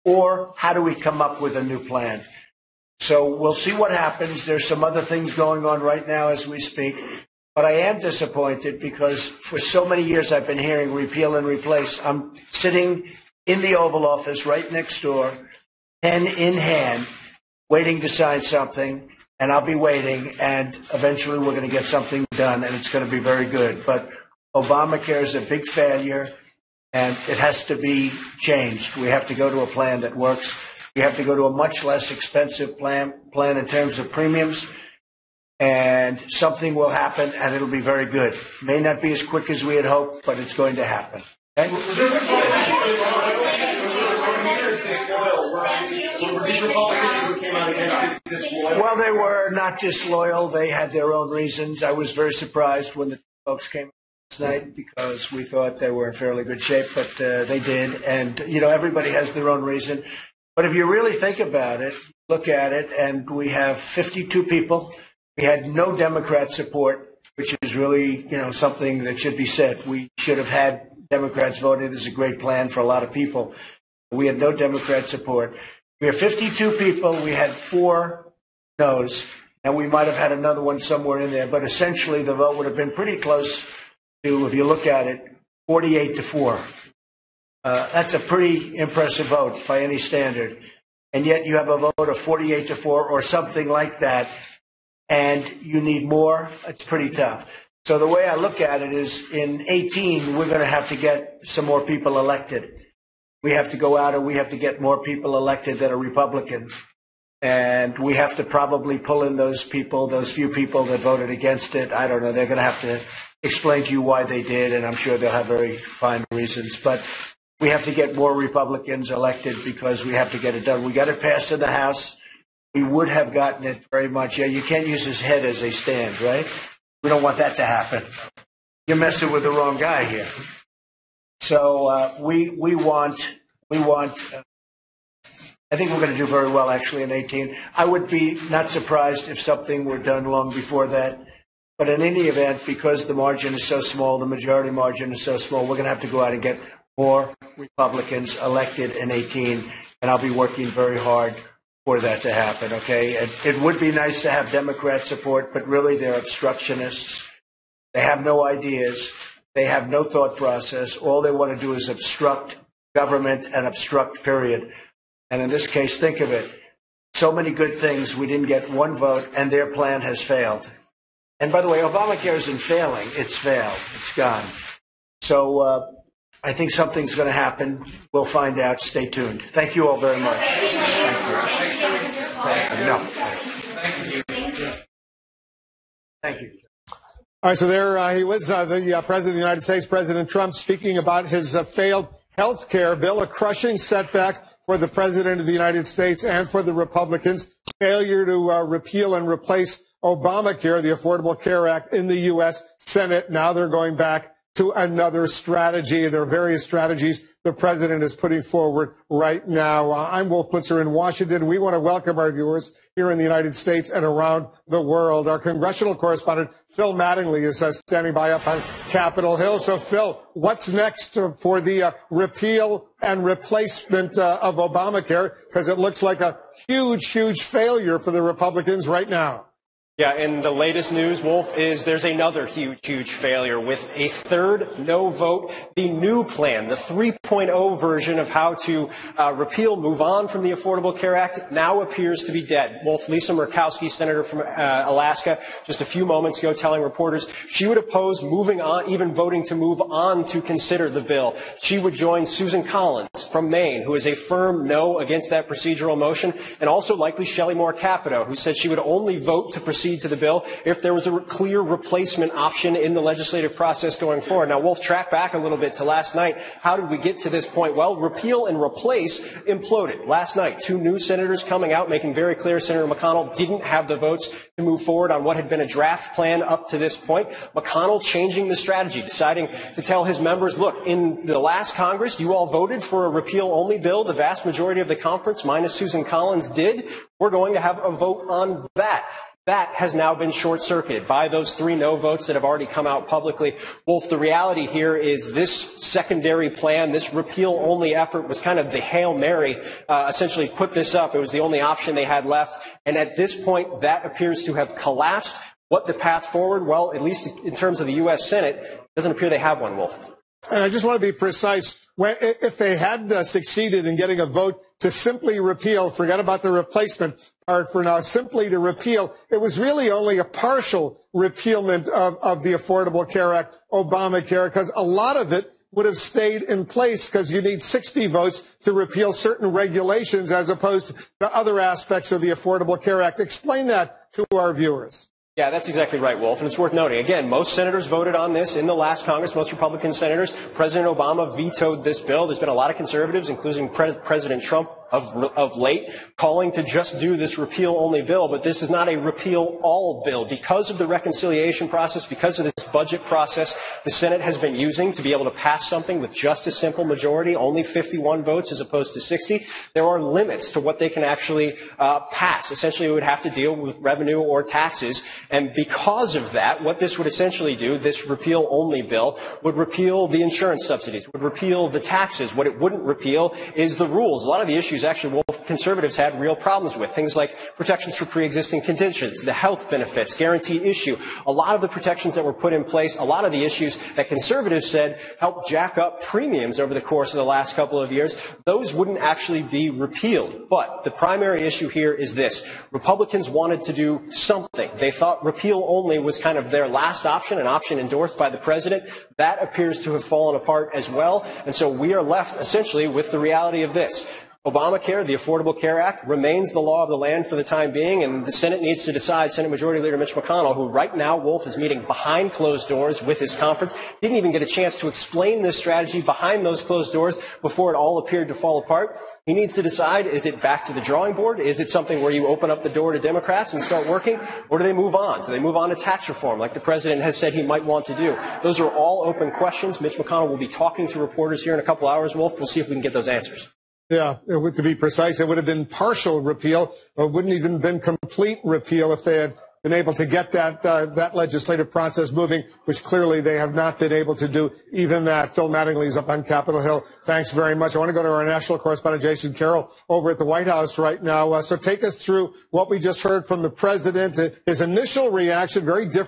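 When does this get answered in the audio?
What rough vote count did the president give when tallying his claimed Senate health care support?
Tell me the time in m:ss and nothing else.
1:32.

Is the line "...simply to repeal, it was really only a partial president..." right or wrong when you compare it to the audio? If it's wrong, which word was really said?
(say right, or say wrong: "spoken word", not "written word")
wrong: "repealment", not "president".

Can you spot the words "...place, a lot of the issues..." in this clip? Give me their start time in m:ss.
6:22.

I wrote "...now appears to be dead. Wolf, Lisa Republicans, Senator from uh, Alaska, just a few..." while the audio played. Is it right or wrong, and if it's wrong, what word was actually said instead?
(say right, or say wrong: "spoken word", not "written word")
wrong: "Murkowski", not "Republicans".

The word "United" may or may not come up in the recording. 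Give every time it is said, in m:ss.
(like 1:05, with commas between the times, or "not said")
3:09, 3:15, 3:33.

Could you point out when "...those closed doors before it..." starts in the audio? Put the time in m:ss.
6:56.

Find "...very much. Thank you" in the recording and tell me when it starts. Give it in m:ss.
2:59.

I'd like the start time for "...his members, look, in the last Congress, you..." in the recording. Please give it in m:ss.
4:40.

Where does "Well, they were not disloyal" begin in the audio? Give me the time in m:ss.
0:48.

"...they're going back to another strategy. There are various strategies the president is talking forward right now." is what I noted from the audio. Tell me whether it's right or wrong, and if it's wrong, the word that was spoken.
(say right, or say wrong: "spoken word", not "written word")
wrong: "putting", not "talking".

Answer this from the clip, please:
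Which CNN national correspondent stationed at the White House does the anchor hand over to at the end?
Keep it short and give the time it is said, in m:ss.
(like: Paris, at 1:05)
Jason Carroll, at 7:29.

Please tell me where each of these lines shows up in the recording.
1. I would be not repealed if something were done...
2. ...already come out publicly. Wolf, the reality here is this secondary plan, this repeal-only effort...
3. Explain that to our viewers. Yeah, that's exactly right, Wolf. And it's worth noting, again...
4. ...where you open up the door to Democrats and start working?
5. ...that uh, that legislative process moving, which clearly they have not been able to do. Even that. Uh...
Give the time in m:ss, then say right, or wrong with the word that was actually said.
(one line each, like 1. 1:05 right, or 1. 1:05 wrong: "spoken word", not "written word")
1. 2:17 wrong: "surprised", not "repealed"
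2. 4:52 right
3. 5:33 right
4. 7:02 right
5. 7:20 right.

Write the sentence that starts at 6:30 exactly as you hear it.
But the primary issue here is this.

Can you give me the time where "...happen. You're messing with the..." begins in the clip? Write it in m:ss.
2:07.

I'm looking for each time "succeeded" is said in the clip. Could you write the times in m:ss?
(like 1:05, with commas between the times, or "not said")
5:13.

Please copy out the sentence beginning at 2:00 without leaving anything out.
We got it passed in the House.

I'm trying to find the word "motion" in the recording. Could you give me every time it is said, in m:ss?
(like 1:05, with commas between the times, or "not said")
4:15.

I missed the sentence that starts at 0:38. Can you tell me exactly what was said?
May not be as quick as we had hoped, but it's going to happen.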